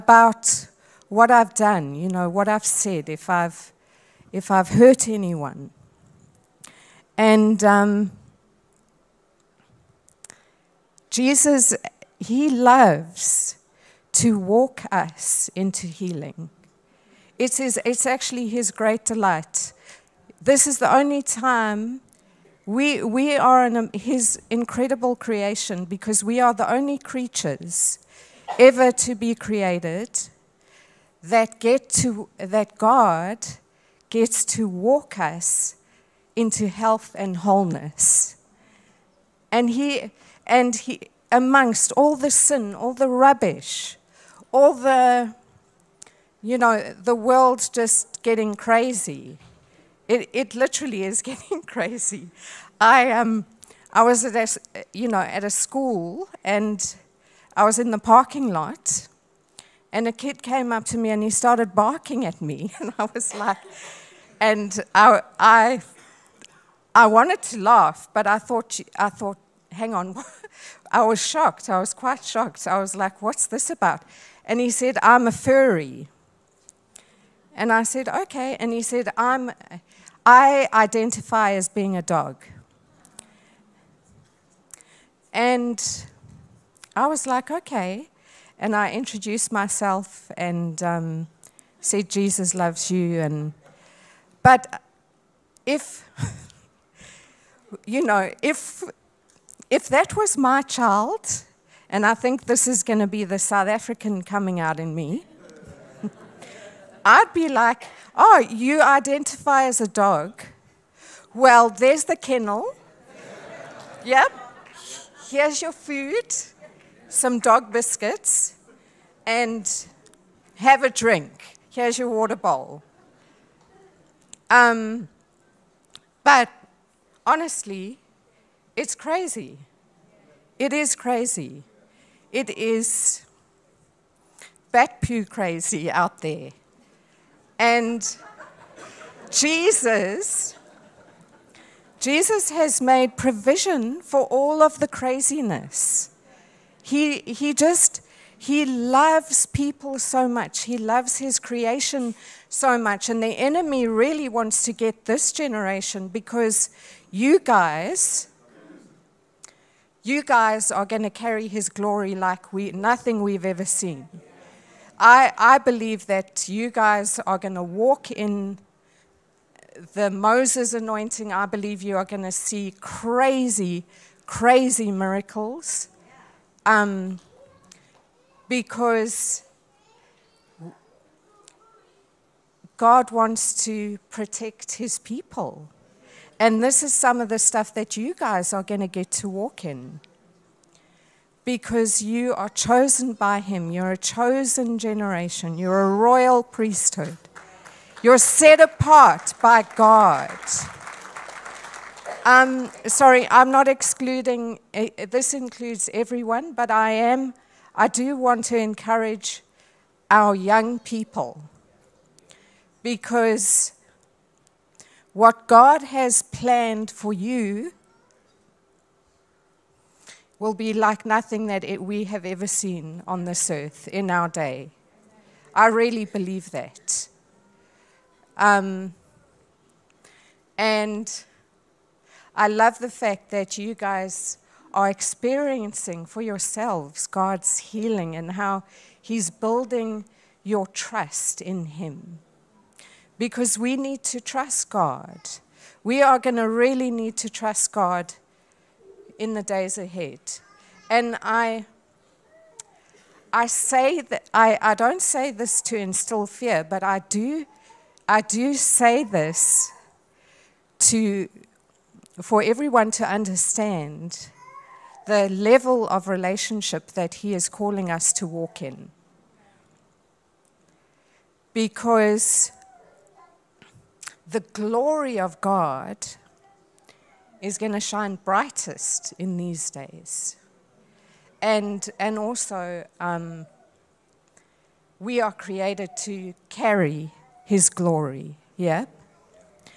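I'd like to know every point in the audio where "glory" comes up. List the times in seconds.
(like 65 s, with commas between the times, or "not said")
161 s, 274 s, 287 s.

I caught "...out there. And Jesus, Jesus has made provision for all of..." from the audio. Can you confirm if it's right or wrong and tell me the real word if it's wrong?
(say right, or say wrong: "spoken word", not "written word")
right.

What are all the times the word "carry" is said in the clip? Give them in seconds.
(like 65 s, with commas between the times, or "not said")
161 s, 286 s.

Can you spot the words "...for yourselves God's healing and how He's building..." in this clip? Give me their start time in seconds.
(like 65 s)
236 s.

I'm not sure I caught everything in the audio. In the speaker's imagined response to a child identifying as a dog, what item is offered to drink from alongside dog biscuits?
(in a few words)
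Water bowl.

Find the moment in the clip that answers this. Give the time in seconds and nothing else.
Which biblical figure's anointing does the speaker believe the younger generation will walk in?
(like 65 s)
170 s.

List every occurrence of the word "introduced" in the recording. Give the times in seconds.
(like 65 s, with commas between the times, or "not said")
88 s.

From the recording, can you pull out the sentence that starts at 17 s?
It's, his, it's actually his great delight.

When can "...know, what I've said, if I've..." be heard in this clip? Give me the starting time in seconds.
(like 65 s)
2 s.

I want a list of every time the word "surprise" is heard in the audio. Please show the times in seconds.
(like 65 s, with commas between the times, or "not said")
not said.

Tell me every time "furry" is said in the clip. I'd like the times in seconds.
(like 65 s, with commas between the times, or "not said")
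75 s.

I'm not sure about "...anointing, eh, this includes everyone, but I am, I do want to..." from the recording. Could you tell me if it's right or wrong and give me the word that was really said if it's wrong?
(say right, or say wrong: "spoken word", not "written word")
wrong: "excluding", not "anointing".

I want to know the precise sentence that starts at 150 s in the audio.
He loves his creation so much.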